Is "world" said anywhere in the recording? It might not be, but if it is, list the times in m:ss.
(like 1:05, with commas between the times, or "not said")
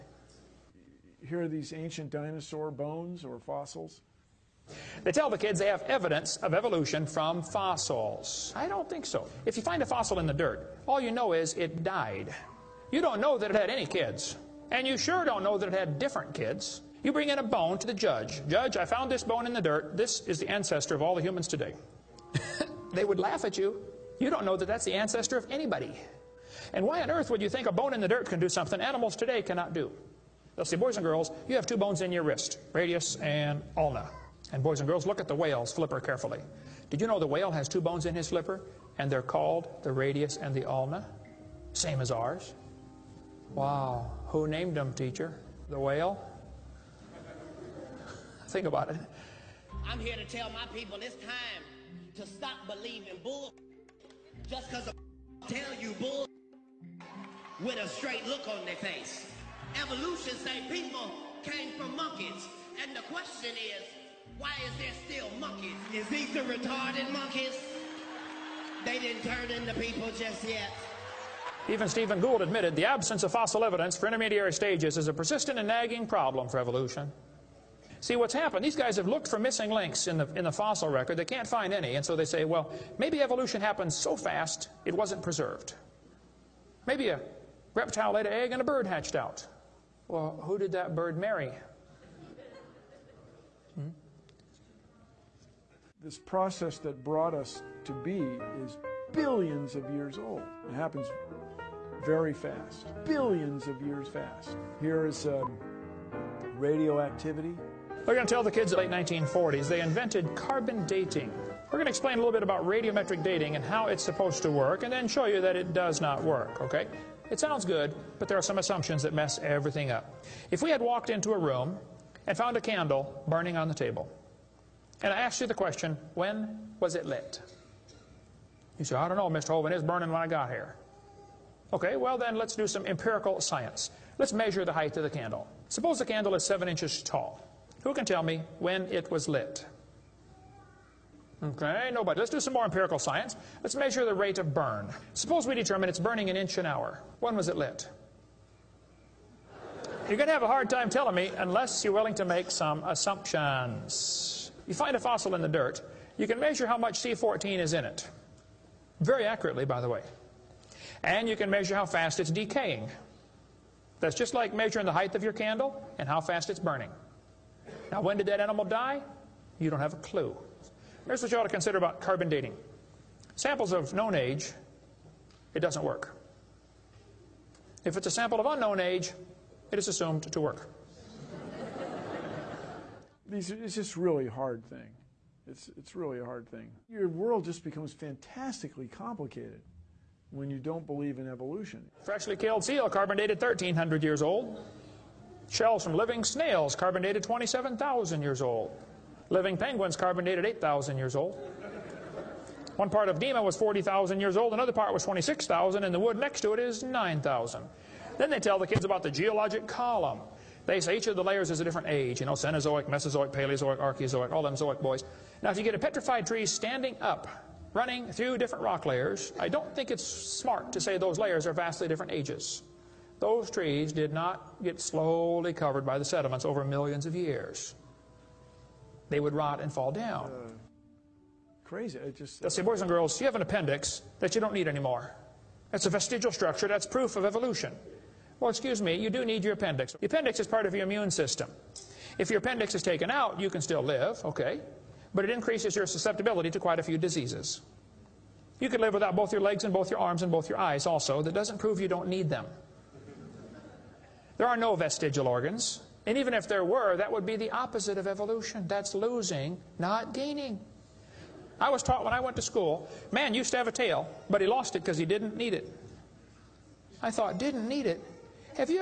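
3:07.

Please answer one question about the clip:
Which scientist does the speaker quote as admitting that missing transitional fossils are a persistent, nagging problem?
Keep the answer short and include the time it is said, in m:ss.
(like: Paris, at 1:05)
Stephen Gould, at 1:11.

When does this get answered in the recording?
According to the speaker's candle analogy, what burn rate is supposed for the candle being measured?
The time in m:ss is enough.
2:26.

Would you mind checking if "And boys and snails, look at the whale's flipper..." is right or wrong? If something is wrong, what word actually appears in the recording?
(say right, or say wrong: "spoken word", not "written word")
wrong: "girls", not "snails".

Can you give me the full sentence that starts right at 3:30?
They say each of the layers is a different age, you know, Cenozoic, Mesozoic, Paleozoic, Archeozoic, all them Zoic boys.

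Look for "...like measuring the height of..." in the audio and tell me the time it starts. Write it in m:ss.
2:44.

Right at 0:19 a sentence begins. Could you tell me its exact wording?
This is the ancestor of all the humans today.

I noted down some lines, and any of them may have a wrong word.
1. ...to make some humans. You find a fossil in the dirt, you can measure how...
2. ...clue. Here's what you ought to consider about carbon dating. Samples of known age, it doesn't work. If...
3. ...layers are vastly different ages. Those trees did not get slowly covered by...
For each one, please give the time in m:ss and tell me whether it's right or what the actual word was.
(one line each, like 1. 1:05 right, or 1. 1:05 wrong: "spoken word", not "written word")
1. 2:32 wrong: "assumptions", not "humans"
2. 2:49 right
3. 3:41 right.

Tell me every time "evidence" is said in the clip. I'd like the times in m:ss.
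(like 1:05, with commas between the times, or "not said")
0:05, 1:13.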